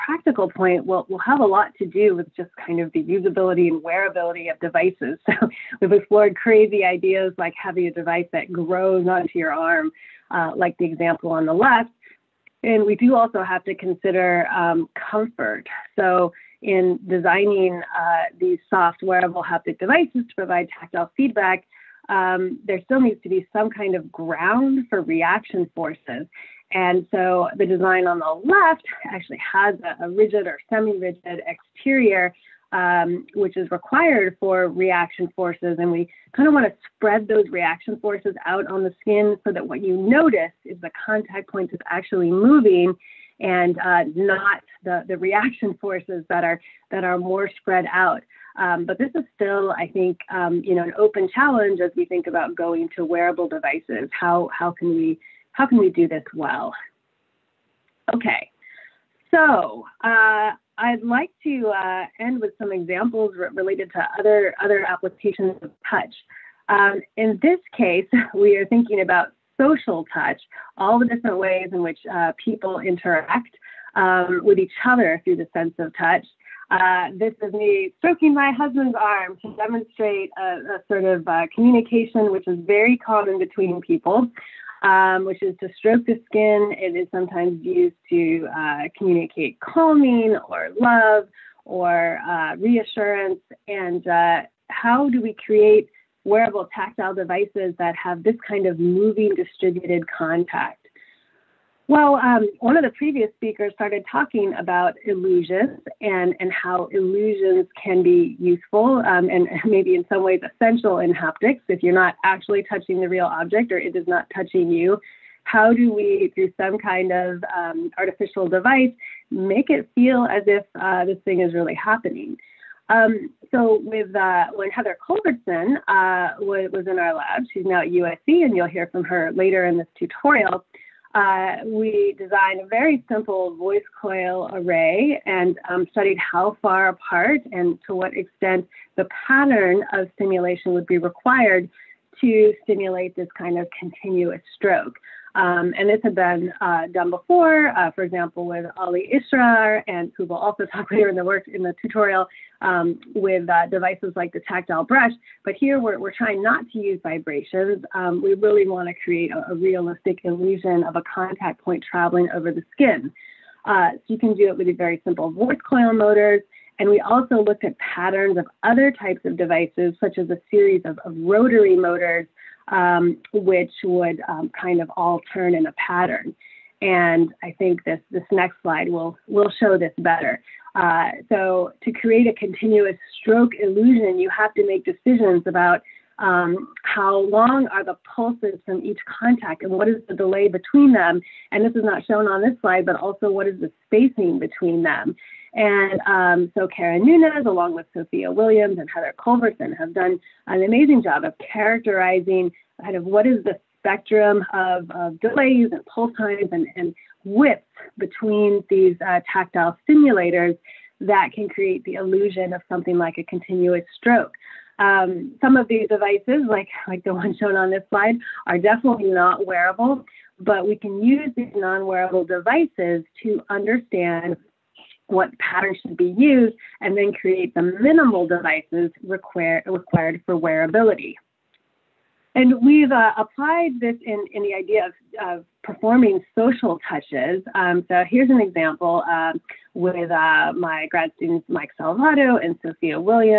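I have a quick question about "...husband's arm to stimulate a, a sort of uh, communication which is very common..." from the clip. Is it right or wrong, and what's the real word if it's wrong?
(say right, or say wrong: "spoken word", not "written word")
wrong: "demonstrate", not "stimulate".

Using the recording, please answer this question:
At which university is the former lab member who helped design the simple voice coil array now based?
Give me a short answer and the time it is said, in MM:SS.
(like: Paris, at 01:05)
USC, at 02:07.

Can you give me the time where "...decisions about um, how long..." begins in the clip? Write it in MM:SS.
03:04.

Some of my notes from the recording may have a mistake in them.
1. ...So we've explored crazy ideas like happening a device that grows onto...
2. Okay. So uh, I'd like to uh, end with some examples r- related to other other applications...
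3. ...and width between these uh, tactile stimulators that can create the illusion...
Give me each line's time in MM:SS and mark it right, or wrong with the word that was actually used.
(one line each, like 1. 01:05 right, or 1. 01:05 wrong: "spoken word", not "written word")
1. 00:05 wrong: "having", not "happening"
2. 00:58 right
3. 03:26 right.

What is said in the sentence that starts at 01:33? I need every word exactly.
And uh, how do we create wearable tactile devices that have this kind of moving distributed contact?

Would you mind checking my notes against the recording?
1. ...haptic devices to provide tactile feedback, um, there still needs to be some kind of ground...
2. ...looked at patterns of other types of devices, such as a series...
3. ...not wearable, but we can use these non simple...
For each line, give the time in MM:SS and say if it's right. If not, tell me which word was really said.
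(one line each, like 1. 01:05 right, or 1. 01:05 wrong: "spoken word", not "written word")
1. 00:19 right
2. 02:47 right
3. 03:39 wrong: "wearable", not "simple".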